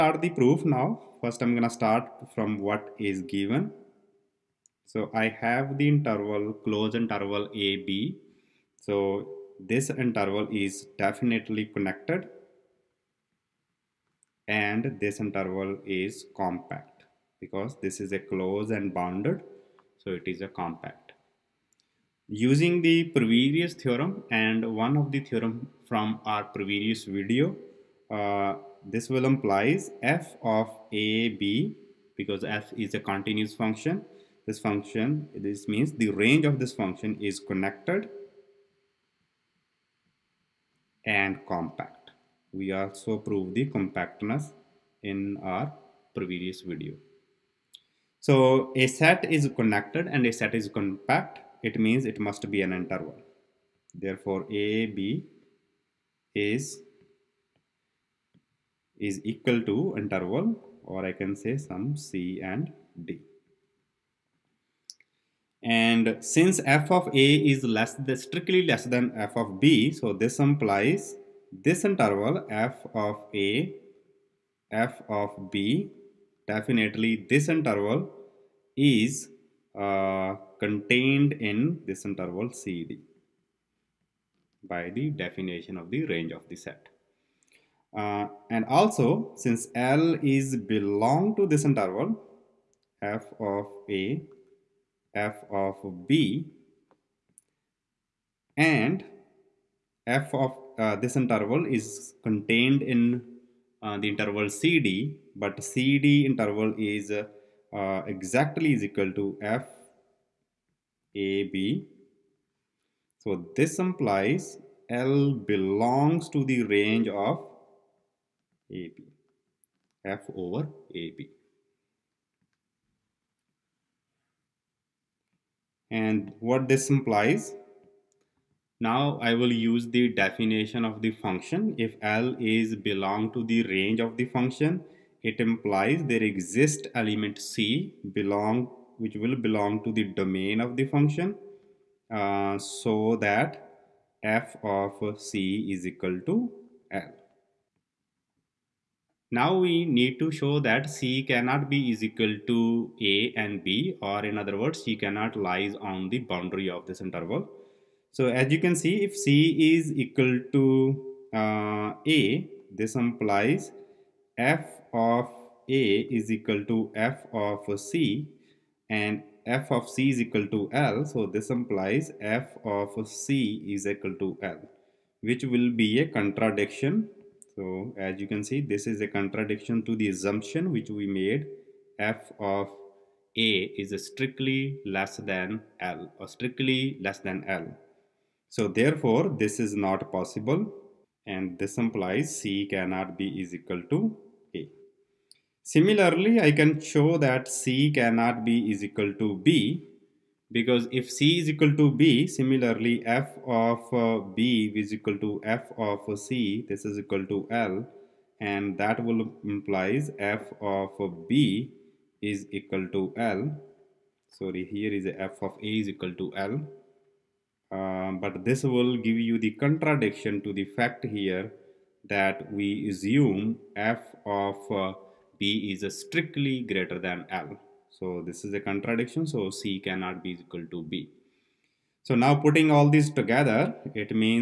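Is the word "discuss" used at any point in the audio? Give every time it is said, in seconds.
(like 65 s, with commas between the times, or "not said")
not said.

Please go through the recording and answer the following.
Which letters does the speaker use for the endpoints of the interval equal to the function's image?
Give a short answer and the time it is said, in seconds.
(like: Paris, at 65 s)
C and D, at 61 s.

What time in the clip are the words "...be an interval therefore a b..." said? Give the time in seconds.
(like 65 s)
52 s.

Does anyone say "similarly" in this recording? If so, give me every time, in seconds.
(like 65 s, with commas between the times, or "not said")
195 s, 202 s.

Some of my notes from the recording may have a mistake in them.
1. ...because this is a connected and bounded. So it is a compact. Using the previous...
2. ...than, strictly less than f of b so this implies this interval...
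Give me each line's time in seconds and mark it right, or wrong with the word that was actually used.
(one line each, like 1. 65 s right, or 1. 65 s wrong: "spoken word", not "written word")
1. 17 s wrong: "closed", not "connected"
2. 68 s right.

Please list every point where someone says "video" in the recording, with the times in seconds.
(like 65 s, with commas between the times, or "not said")
27 s, 46 s.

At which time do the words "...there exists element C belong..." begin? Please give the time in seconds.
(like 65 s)
136 s.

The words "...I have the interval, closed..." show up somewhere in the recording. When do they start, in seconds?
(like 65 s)
5 s.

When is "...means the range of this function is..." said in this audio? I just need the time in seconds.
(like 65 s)
35 s.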